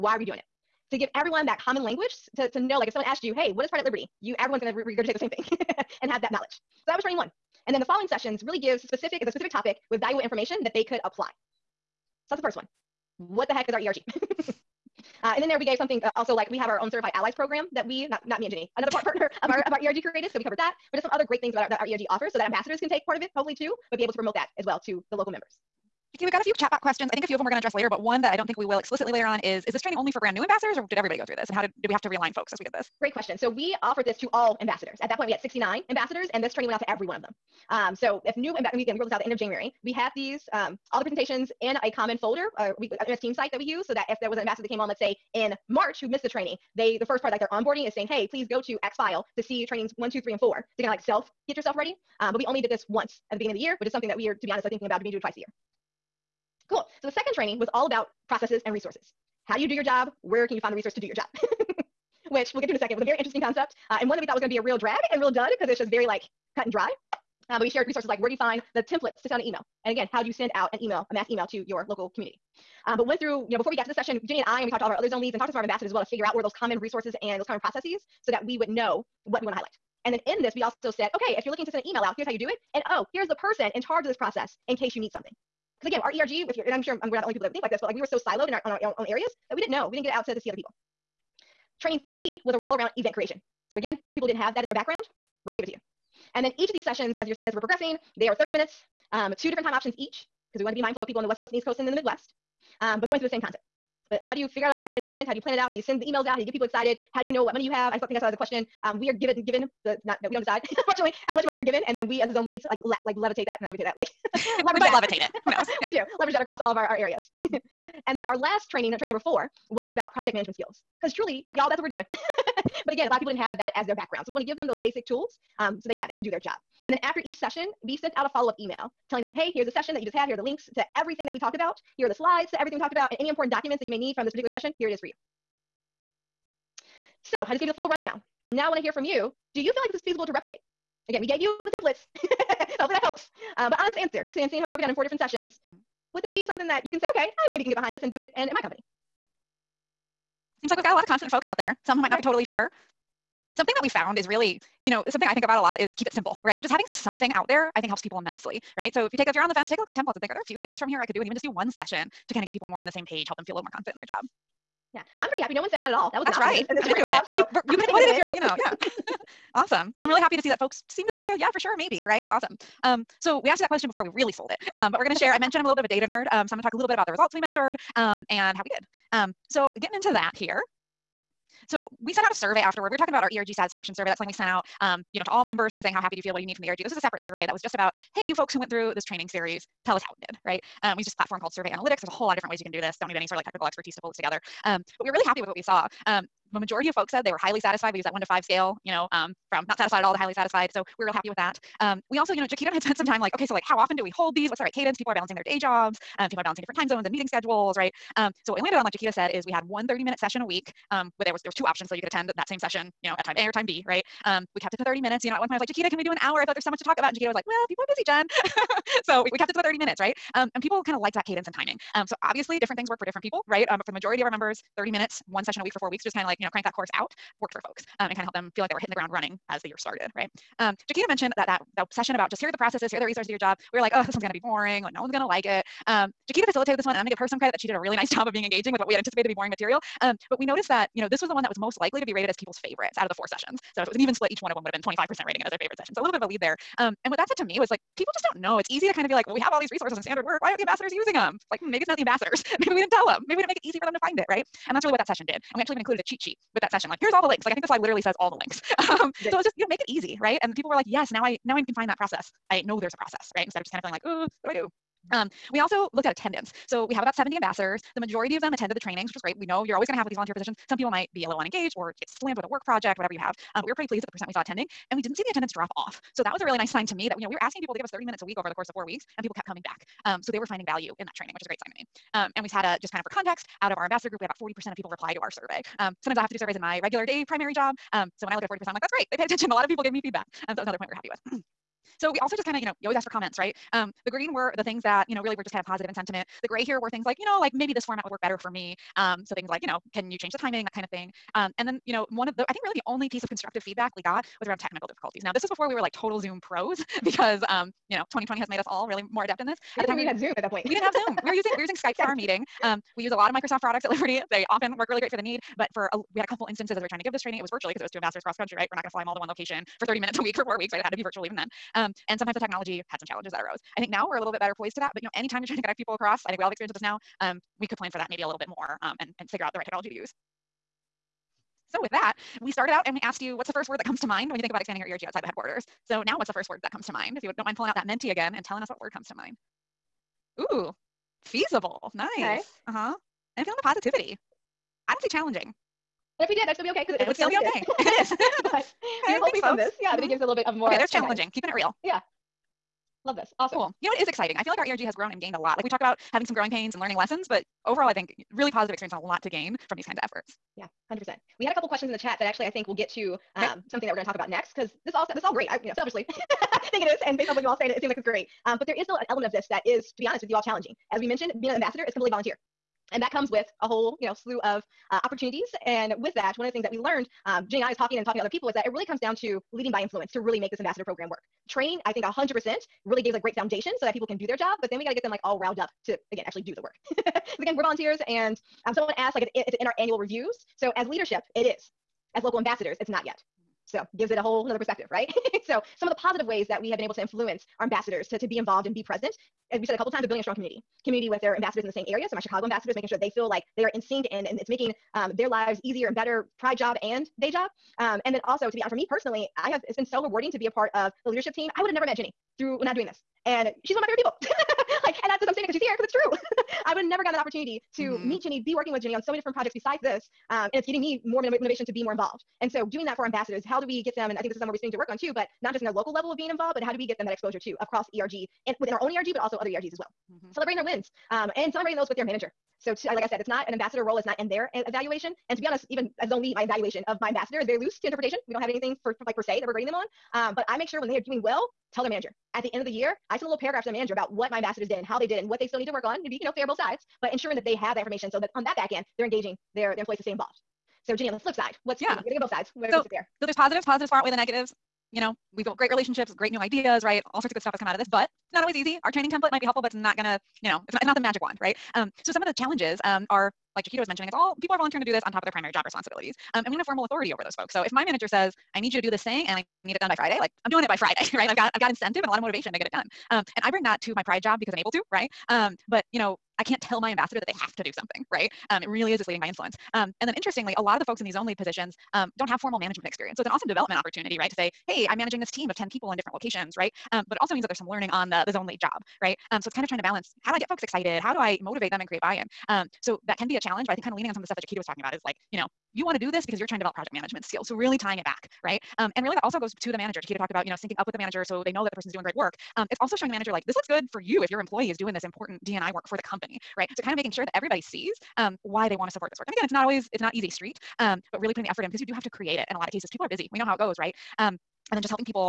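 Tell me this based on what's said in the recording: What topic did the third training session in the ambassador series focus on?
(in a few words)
Event creation.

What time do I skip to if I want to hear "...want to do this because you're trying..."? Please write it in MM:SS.
08:15.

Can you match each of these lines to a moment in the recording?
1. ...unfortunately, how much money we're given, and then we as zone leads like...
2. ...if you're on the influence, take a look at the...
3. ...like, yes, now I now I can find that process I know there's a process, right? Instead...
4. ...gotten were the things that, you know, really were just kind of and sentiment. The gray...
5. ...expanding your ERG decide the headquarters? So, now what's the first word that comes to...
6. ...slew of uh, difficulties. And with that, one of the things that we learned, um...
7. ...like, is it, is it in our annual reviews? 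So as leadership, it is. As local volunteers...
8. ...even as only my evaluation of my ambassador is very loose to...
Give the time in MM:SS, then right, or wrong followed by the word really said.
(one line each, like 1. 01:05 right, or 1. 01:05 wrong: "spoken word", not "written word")
1. 01:50 right
2. 02:39 wrong: "fence", not "influence"
3. 04:20 right
4. 04:54 wrong: "green", not "gotten"
5. 05:34 wrong: "outside", not "decide"
6. 06:14 wrong: "opportunities", not "difficulties"
7. 06:29 wrong: "ambassadors", not "volunteers"
8. 07:15 right.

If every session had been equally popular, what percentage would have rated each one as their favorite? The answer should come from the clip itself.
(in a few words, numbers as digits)
25%.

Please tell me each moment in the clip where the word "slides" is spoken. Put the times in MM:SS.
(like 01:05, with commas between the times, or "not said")
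02:12, 04:17.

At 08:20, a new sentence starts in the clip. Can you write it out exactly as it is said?
Jaquita talked about, you know, syncing up with the manager so they know that the person's doing great work.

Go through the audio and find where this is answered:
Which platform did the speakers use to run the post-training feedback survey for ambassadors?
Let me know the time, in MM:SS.
03:11.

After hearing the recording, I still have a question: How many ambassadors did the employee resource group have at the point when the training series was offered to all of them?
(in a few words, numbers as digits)
69.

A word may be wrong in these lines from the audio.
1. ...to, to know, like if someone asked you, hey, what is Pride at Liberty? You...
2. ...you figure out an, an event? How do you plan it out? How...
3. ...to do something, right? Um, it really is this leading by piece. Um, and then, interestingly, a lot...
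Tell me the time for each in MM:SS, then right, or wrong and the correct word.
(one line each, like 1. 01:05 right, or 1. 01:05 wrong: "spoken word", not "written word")
1. 00:02 right
2. 01:44 right
3. 07:57 wrong: "influence", not "piece".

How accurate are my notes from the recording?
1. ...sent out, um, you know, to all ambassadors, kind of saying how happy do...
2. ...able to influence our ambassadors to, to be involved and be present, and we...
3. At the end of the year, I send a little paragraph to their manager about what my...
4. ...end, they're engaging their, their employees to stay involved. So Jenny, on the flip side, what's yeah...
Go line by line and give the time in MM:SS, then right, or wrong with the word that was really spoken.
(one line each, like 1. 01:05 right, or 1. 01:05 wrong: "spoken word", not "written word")
1. 03:04 wrong: "members", not "ambassadors"
2. 06:36 right
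3. 07:22 right
4. 07:28 right.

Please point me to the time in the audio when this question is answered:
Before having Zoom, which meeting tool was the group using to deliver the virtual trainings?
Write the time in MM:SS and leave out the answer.
05:11.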